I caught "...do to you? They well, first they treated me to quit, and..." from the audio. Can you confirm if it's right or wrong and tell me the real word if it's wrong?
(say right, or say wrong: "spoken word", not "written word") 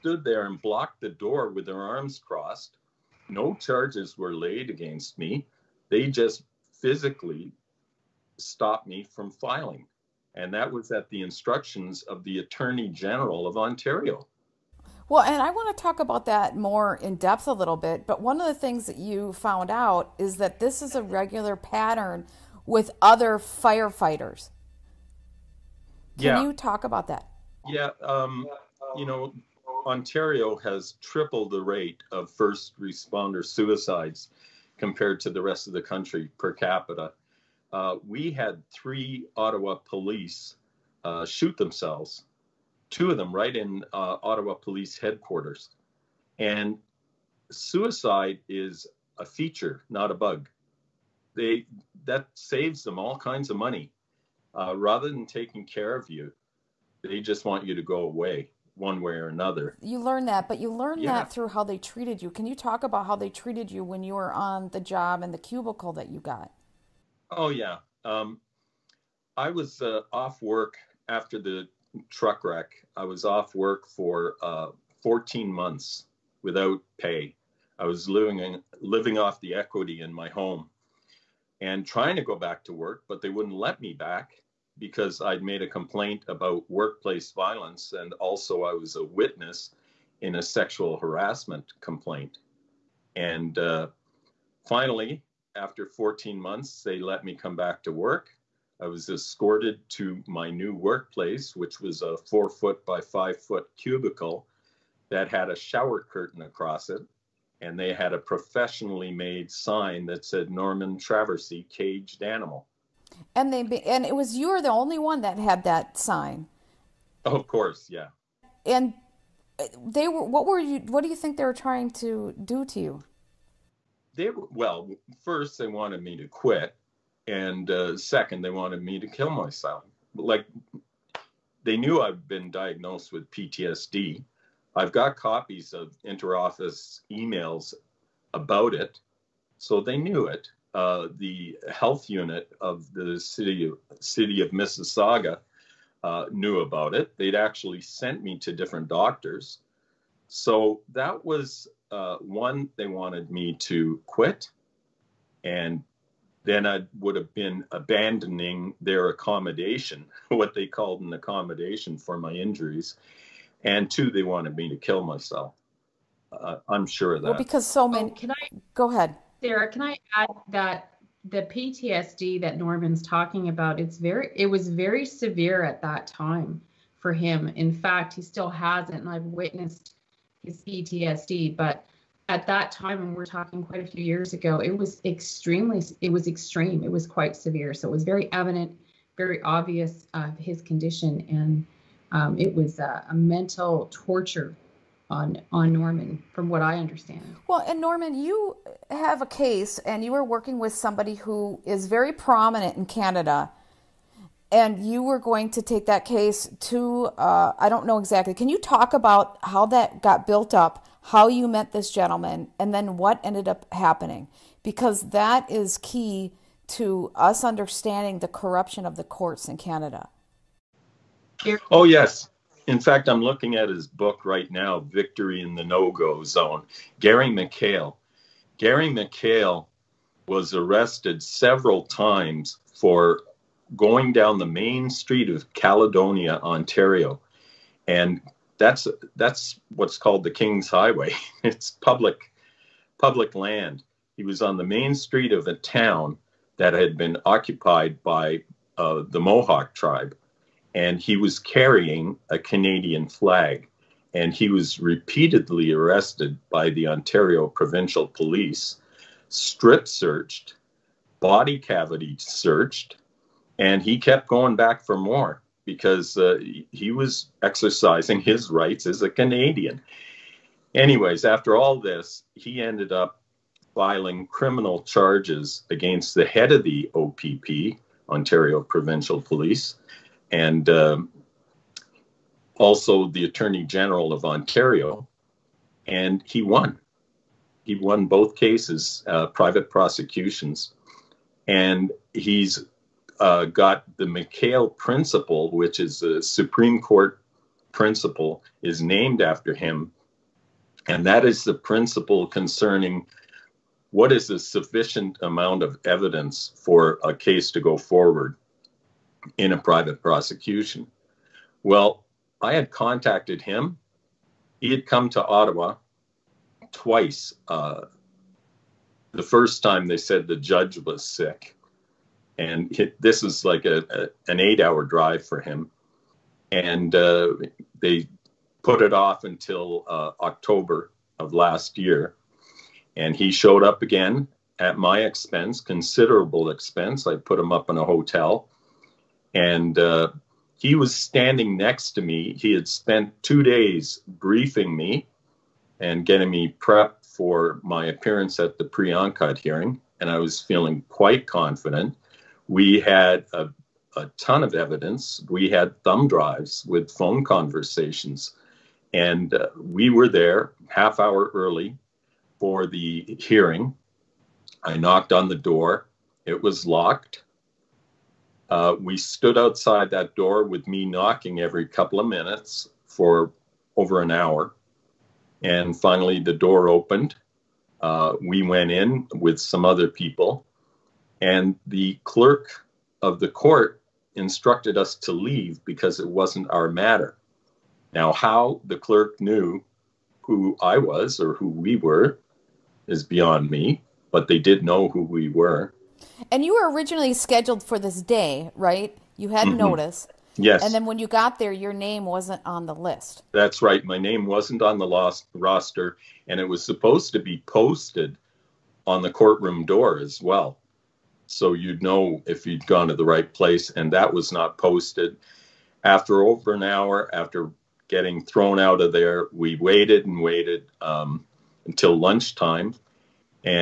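wrong: "wanted", not "treated".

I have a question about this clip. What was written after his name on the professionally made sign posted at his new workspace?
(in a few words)
Caged animal.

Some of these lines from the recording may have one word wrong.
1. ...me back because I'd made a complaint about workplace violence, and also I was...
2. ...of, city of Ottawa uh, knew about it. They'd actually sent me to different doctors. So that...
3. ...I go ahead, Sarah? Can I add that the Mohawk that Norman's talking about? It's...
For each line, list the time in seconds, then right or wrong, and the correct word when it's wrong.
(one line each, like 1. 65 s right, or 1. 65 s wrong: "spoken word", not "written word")
1. 83 s right
2. 143 s wrong: "Mississauga", not "Ottawa"
3. 168 s wrong: "PTSD", not "Mohawk".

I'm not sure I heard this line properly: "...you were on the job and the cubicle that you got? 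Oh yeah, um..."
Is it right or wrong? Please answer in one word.
right.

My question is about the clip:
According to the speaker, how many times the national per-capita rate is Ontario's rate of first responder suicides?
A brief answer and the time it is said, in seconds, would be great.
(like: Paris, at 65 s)
Triple, at 30 s.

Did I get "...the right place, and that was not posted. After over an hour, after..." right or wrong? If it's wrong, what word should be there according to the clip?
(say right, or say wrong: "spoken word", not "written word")
right.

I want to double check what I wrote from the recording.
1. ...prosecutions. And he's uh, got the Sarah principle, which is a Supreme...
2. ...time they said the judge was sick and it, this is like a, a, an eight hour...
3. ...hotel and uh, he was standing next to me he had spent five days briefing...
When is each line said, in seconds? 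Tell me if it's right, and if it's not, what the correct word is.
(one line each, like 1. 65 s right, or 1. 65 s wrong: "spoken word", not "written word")
1. 289 s wrong: "McHale", not "Sarah"
2. 319 s right
3. 337 s wrong: "two", not "five".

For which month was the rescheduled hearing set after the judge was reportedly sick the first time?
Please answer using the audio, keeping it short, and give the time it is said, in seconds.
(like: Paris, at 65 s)
October, at 330 s.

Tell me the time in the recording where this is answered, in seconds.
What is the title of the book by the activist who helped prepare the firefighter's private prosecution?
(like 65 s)
224 s.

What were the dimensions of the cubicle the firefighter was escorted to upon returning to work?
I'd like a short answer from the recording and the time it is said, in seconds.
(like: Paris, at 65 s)
4 feet by 5 feet, at 102 s.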